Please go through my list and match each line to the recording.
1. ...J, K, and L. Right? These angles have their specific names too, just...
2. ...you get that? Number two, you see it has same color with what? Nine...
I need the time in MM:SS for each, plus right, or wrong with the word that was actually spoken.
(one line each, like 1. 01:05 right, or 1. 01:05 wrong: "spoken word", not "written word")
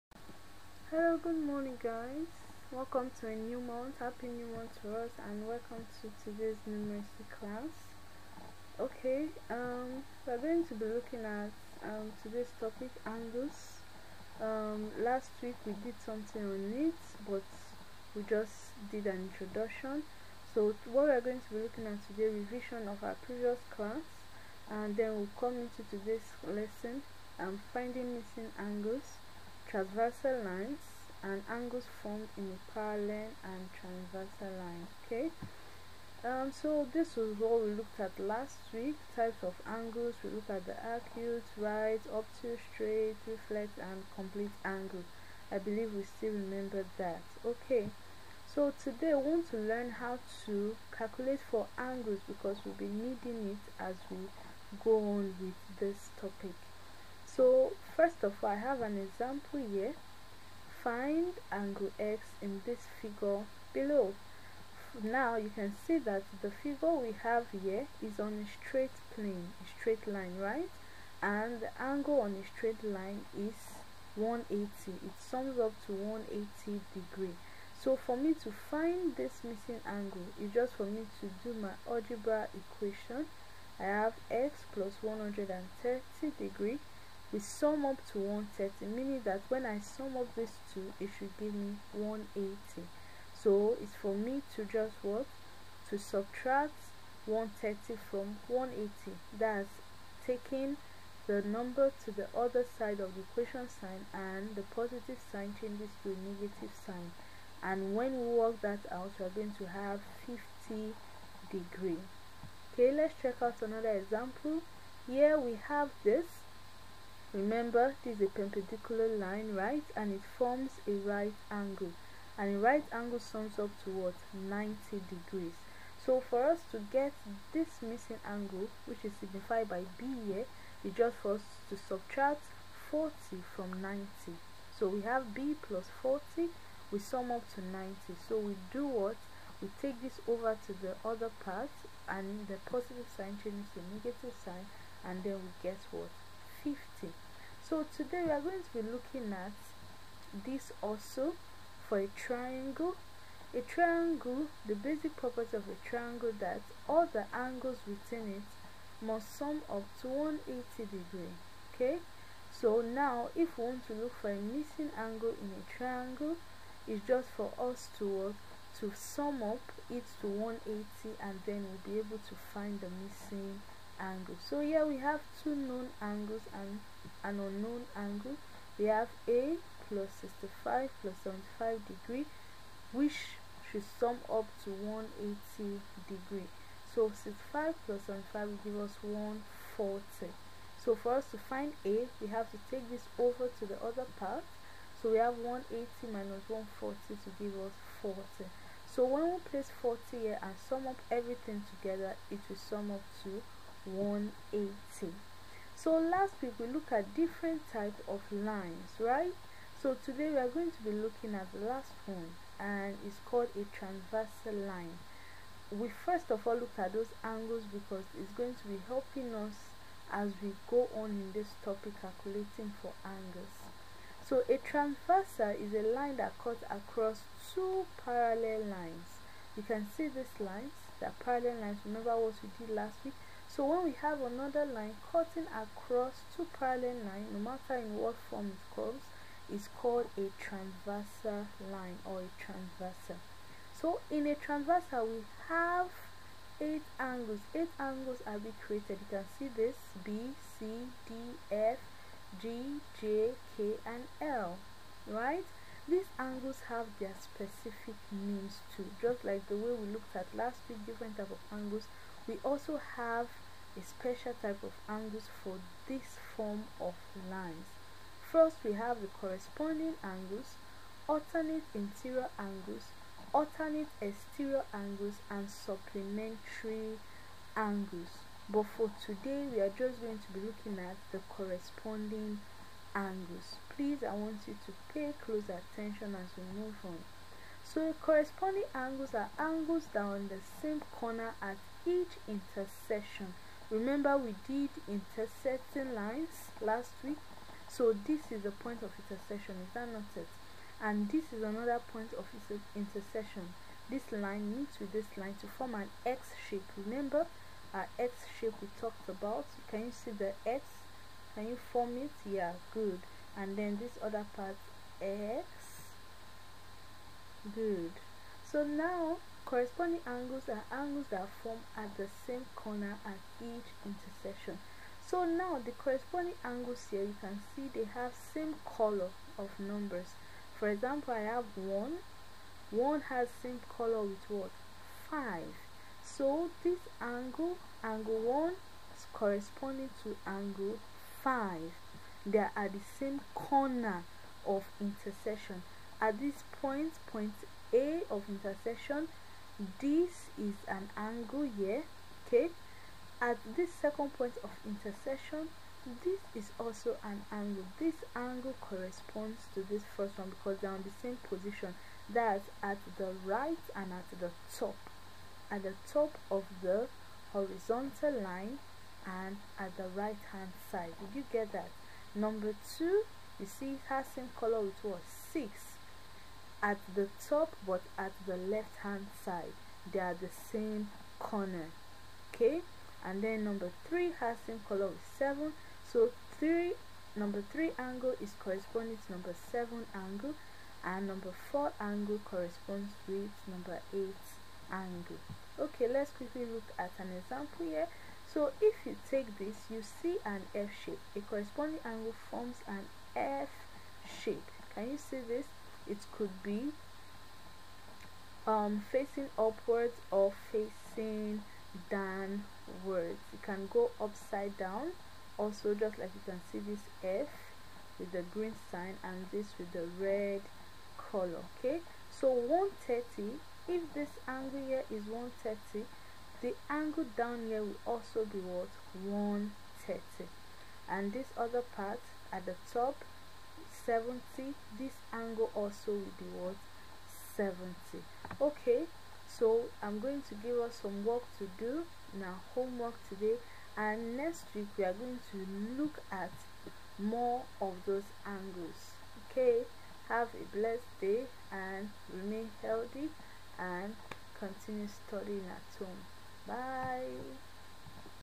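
1. 04:13 right
2. 06:11 wrong: "Six", not "Nine".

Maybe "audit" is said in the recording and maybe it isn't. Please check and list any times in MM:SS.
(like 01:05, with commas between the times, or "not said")
not said.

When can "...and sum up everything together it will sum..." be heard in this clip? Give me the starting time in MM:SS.
03:20.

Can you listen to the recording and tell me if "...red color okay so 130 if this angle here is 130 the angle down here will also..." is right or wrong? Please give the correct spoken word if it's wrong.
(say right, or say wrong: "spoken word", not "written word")
right.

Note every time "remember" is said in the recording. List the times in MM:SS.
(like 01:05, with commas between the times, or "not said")
00:46, 01:57, 03:51, 04:53, 05:06.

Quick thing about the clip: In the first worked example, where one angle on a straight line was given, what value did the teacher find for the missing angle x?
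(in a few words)
50 degrees.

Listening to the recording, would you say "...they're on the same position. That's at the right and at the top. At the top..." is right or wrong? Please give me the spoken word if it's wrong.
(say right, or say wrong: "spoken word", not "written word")
right.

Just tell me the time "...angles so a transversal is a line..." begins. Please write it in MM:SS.
03:43.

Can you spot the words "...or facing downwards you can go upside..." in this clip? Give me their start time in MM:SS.
06:50.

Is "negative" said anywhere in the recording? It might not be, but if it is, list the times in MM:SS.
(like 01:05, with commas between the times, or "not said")
01:46, 02:23.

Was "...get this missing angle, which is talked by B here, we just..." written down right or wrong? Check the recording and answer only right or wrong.
wrong.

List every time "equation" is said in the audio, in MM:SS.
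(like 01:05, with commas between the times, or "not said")
01:22, 01:43.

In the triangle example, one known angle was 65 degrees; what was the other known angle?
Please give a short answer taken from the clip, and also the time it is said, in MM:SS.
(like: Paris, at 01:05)
75 degrees, at 03:01.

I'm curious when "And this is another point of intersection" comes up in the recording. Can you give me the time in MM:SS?
05:00.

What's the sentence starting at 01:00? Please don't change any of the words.
Find angle x in this figure below.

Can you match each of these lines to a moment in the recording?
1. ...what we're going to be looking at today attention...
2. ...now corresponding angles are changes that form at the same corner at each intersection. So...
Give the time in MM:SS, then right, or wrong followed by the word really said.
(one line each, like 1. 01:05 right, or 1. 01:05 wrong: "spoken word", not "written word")
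1. 00:20 wrong: "revision", not "attention"
2. 05:18 wrong: "angles", not "changes".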